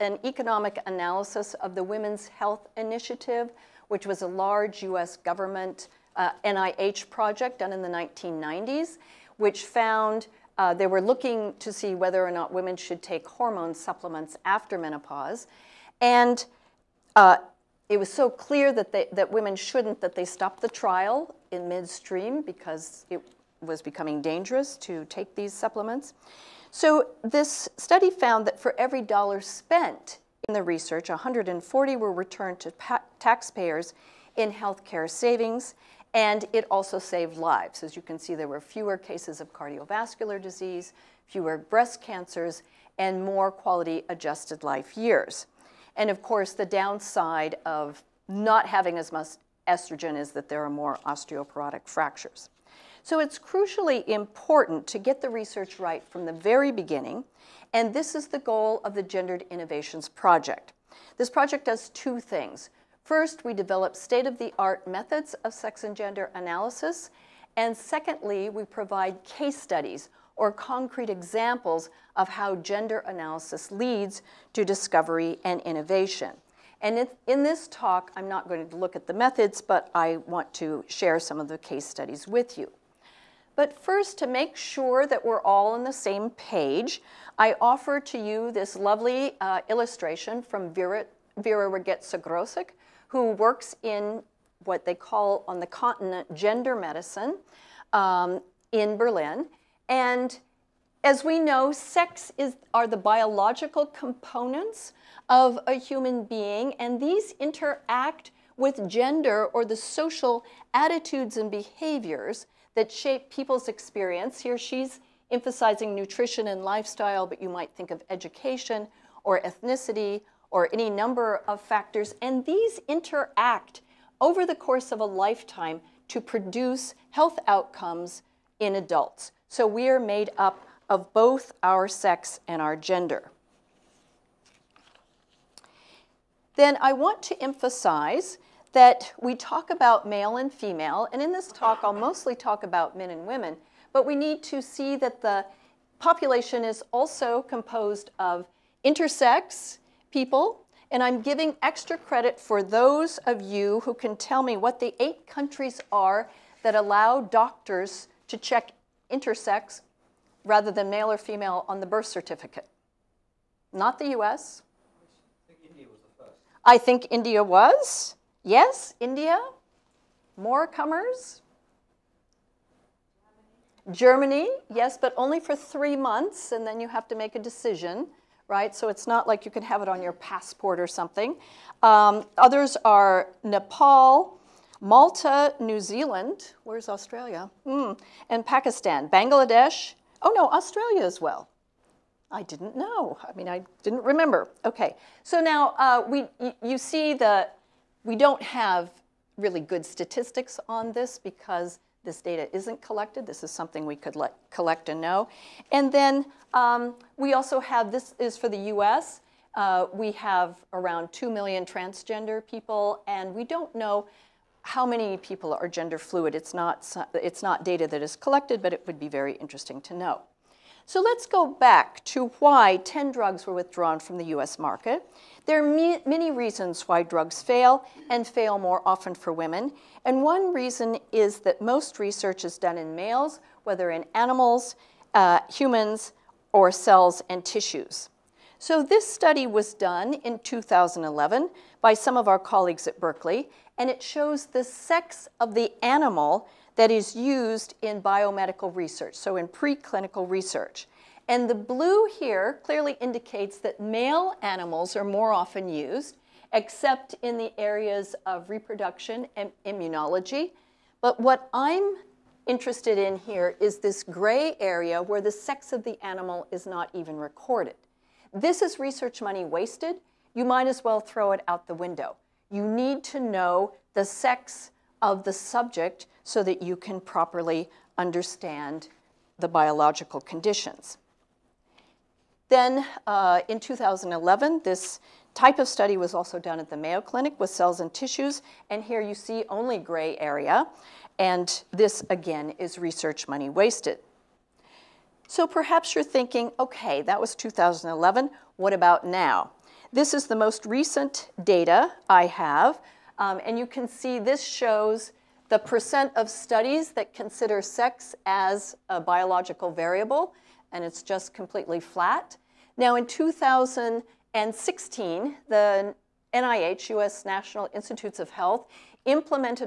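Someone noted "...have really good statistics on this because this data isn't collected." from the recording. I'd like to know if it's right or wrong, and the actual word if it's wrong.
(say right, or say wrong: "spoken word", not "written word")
right.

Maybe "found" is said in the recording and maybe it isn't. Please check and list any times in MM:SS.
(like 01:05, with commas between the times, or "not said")
00:09, 00:28.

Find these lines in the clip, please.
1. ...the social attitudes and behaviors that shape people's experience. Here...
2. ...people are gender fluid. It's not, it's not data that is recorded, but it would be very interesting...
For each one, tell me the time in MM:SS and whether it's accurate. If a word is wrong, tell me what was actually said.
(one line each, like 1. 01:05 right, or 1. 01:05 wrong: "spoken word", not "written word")
1. 01:49 right
2. 03:35 wrong: "collected", not "recorded".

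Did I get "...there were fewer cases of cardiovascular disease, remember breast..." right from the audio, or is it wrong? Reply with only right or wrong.
wrong.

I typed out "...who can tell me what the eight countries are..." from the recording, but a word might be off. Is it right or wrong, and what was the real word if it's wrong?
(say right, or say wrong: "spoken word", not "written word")
right.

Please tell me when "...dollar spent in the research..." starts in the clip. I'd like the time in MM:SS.
00:29.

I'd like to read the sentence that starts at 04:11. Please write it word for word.
And the blue here clearly indicates that male animals are more often used, except in the areas of reproduction and immunology.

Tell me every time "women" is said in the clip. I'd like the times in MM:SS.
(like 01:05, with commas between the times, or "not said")
00:01, 00:12, 00:19, 02:23, 03:49.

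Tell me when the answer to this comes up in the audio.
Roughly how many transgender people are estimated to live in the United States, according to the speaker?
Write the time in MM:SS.
03:31.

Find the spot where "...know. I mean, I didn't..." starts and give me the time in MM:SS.
03:12.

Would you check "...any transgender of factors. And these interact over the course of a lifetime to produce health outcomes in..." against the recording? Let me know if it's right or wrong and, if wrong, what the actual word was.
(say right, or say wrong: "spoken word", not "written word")
wrong: "number", not "transgender".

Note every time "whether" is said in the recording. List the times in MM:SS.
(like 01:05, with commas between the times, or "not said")
00:11, 03:53.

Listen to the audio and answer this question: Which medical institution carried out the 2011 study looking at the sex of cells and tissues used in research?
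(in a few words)
Mayo Clinic.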